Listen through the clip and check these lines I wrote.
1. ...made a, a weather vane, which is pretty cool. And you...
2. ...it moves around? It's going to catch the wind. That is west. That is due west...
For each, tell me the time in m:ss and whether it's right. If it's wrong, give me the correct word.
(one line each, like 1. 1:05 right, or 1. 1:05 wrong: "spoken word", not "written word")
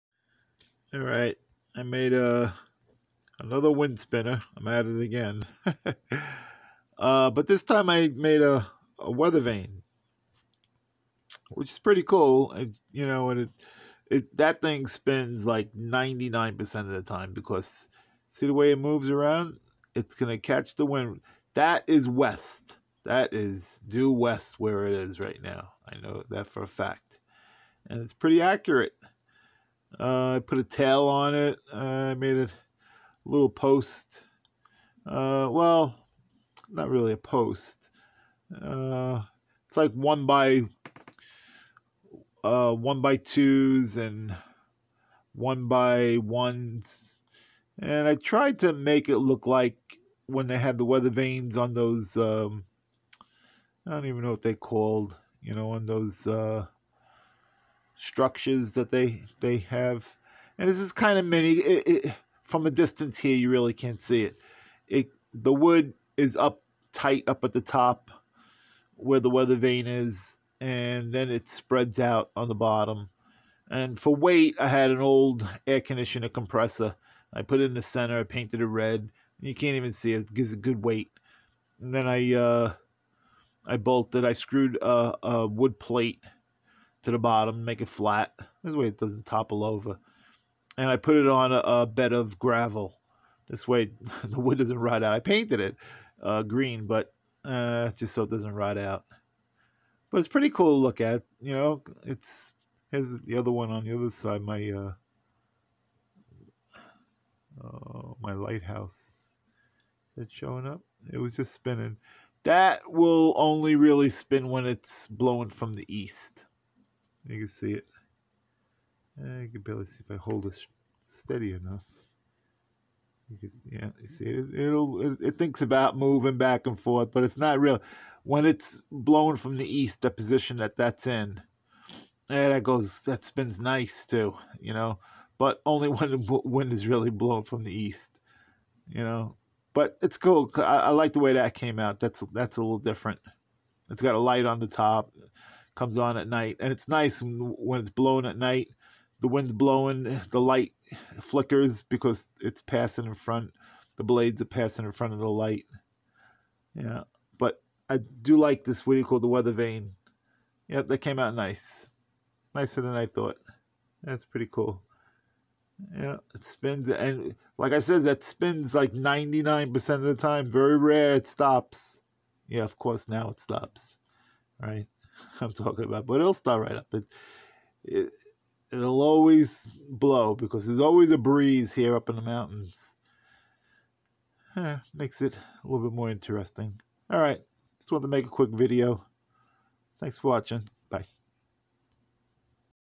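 1. 0:08 right
2. 0:18 right.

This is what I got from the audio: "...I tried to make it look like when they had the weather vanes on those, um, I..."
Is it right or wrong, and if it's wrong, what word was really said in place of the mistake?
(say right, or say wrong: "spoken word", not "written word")
right.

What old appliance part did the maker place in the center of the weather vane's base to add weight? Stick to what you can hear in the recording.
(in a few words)
Air conditioner compressor.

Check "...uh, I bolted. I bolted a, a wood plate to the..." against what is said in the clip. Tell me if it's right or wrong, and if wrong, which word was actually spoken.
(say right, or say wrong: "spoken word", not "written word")
wrong: "screwed", not "bolted".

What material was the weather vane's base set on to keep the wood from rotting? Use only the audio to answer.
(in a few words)
Gravel.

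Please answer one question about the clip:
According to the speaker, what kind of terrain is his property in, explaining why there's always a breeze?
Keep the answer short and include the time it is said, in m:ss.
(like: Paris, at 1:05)
Mountains, at 3:02.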